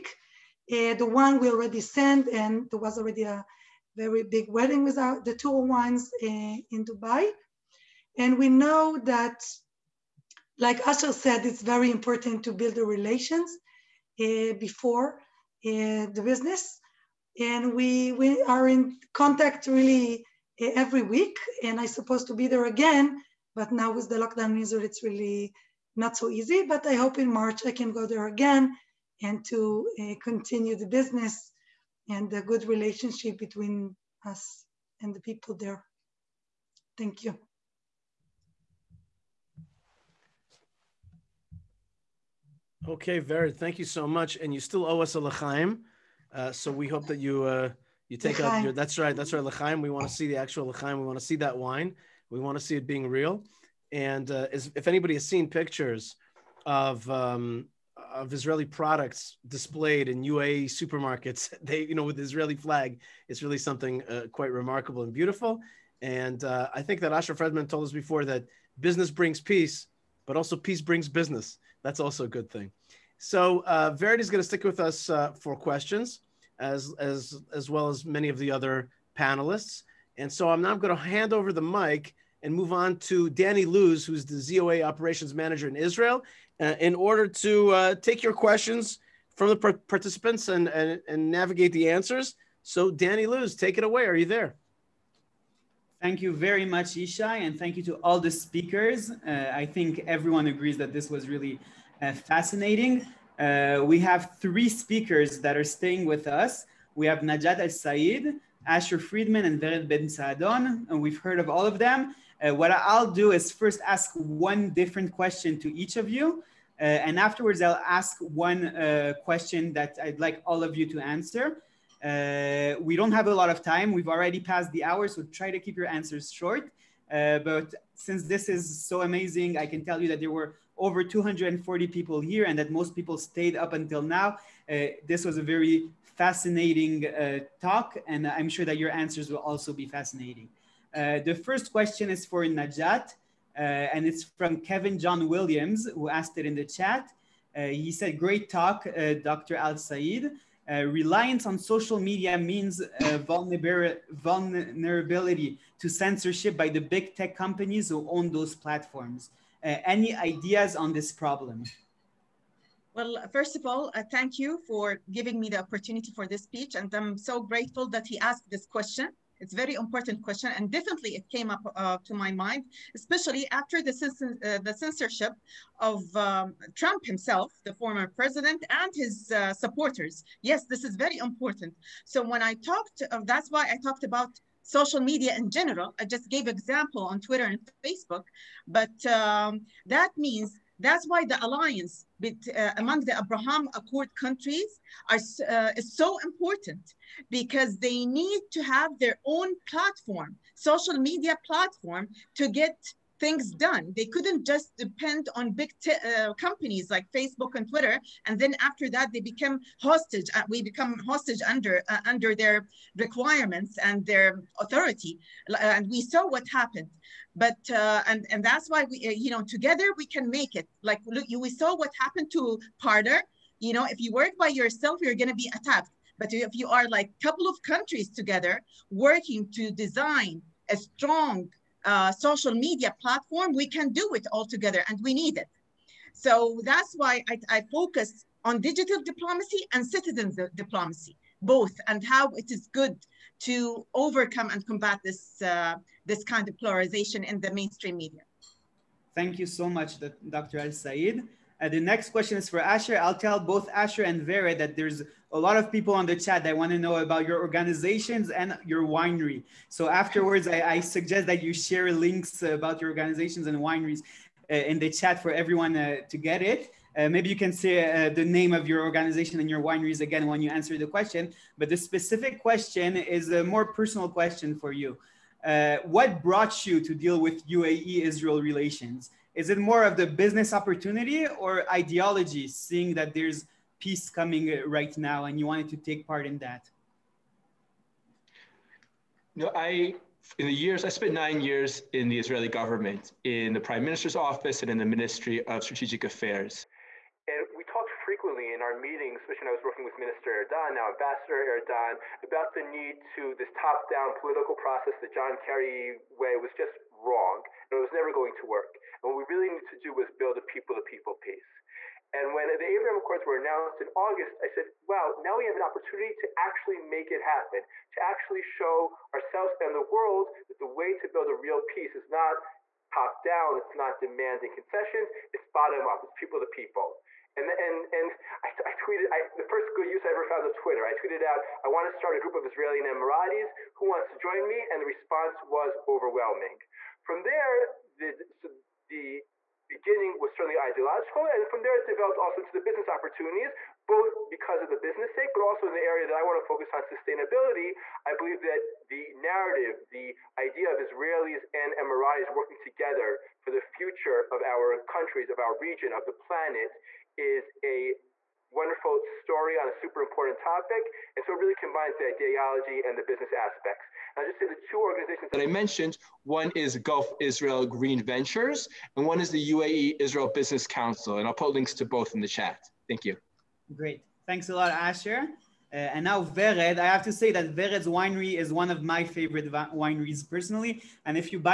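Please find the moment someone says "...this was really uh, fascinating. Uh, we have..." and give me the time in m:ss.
1:40.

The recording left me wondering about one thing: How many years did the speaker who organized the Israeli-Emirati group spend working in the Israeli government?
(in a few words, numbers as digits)
9.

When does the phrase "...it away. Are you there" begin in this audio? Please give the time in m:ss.
1:33.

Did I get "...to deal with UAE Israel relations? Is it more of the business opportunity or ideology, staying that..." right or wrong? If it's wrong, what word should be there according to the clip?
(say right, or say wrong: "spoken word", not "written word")
wrong: "seeing", not "staying".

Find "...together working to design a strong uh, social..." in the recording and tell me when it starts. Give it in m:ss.
3:48.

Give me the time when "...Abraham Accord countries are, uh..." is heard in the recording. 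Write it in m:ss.
3:13.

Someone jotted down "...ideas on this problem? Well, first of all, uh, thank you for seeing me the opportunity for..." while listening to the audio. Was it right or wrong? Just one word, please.
wrong.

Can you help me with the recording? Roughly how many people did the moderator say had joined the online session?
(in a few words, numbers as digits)
over 240.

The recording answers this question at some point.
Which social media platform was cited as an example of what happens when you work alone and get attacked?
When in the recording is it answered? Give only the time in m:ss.
3:42.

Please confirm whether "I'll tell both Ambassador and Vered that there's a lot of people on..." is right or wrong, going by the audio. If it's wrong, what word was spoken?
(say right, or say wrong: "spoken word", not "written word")
wrong: "Asher", not "Ambassador".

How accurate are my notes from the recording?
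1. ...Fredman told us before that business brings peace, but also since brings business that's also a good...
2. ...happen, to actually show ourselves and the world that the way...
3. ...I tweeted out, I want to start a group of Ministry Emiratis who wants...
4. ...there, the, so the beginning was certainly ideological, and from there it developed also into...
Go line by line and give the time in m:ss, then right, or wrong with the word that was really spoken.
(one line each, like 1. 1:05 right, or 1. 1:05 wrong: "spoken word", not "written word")
1. 1:07 wrong: "peace", not "since"
2. 5:17 right
3. 5:30 wrong: "Israeli", not "Ministry"
4. 5:37 right.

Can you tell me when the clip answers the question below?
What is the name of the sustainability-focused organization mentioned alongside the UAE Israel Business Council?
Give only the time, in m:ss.
6:06.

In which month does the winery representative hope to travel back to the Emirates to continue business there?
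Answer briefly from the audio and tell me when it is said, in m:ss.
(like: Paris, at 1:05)
March, at 0:27.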